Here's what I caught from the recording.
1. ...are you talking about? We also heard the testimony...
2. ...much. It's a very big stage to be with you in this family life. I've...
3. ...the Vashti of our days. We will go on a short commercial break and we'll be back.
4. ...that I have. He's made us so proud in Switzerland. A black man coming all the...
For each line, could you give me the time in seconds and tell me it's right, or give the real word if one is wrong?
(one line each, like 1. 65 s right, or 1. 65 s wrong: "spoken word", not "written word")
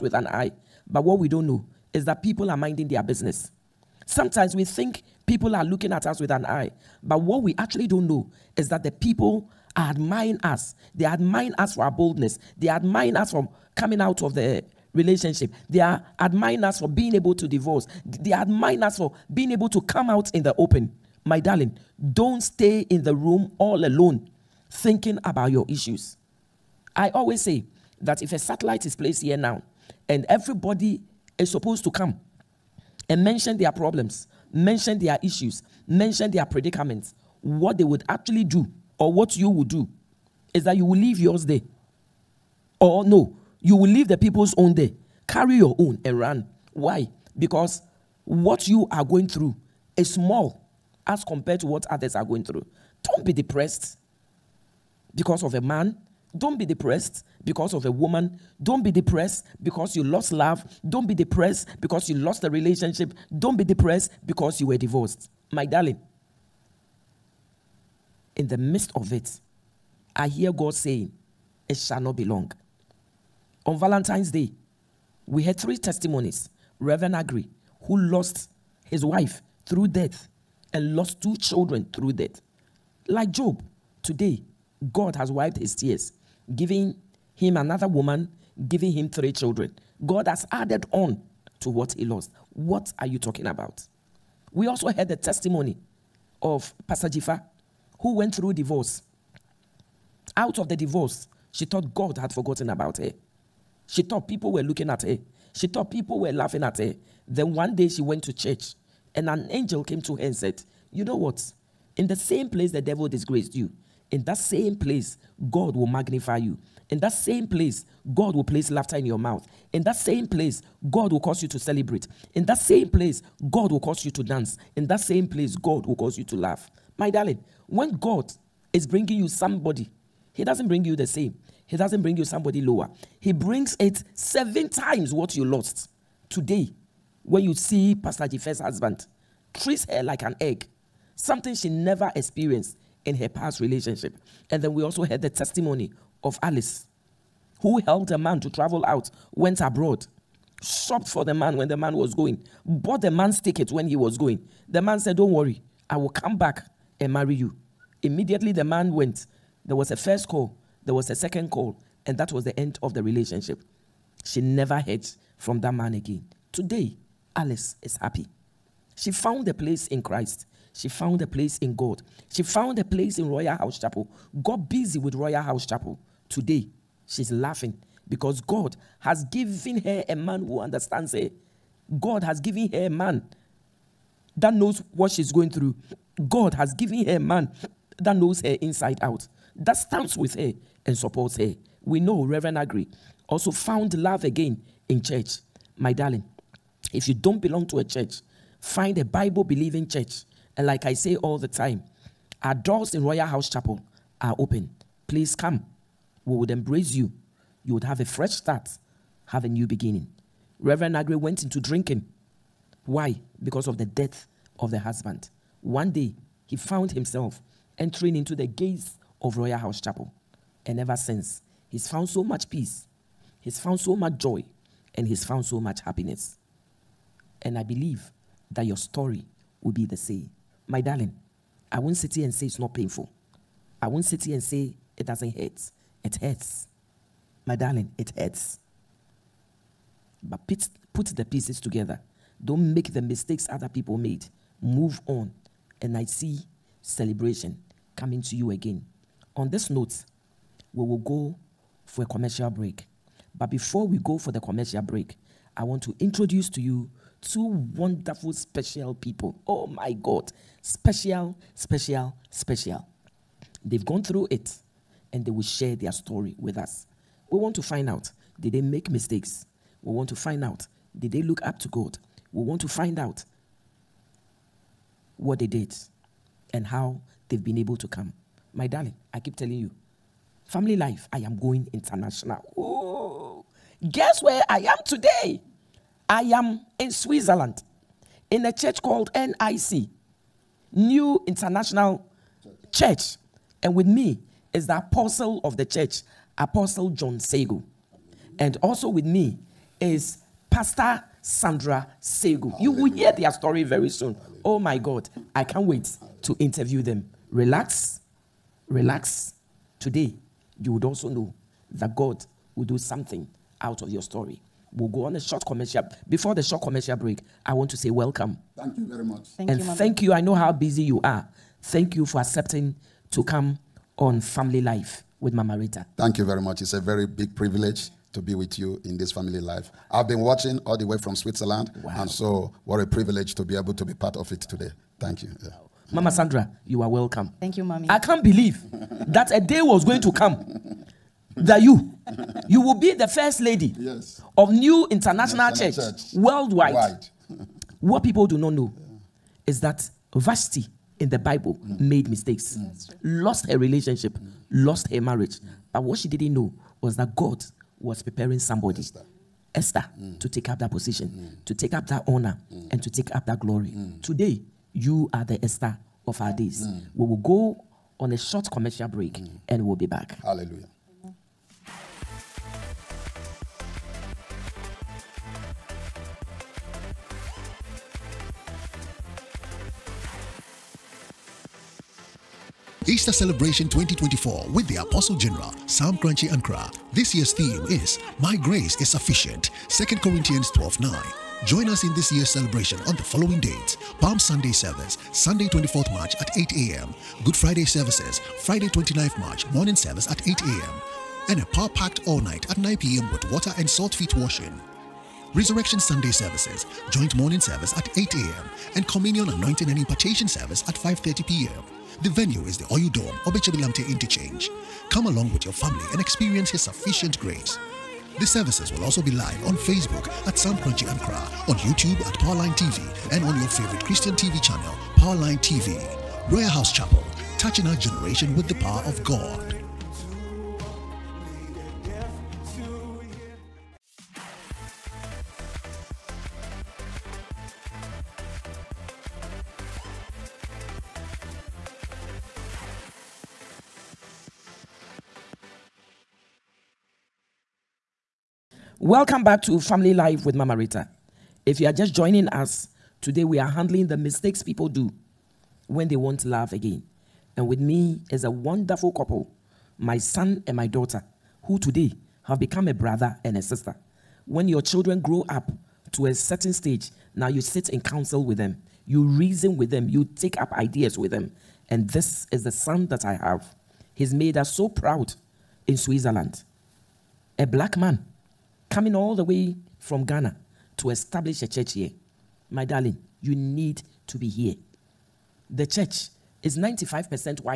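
1. 92 s right
2. 326 s wrong: "privilege", not "stage"
3. 365 s wrong: "Esther", not "Vashti"
4. 472 s right.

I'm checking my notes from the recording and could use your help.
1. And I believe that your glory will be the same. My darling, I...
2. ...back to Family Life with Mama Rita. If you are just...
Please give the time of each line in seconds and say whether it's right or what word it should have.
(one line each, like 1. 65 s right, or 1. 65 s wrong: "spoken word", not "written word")
1. 227 s wrong: "story", not "glory"
2. 449 s right.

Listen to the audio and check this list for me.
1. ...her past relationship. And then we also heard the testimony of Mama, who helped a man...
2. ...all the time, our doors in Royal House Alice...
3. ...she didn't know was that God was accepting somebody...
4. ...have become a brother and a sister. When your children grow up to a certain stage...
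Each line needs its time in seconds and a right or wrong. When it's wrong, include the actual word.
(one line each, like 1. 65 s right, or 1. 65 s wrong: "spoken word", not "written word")
1. 143 s wrong: "Alice", not "Mama"
2. 201 s wrong: "Chapel", not "Alice"
3. 355 s wrong: "preparing", not "accepting"
4. 462 s right.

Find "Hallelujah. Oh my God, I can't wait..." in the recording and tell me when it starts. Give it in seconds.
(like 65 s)
304 s.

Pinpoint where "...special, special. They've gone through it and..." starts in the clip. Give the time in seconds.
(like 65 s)
261 s.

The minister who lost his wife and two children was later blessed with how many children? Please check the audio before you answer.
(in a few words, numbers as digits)
3.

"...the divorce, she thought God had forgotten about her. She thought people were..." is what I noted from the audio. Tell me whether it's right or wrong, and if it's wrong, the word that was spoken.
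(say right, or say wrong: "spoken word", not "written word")
right.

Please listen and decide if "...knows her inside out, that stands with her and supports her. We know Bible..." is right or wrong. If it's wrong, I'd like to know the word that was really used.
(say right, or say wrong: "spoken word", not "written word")
wrong: "Reverend", not "Bible".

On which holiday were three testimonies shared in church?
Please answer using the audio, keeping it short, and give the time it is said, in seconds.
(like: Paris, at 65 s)
Valentine's Day, at 73 s.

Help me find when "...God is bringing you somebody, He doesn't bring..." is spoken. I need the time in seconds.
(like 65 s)
127 s.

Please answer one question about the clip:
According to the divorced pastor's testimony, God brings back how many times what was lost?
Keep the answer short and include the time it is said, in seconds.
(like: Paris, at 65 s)
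7, at 134 s.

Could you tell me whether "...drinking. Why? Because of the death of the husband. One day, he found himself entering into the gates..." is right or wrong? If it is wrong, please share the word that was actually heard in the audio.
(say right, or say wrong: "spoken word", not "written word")
right.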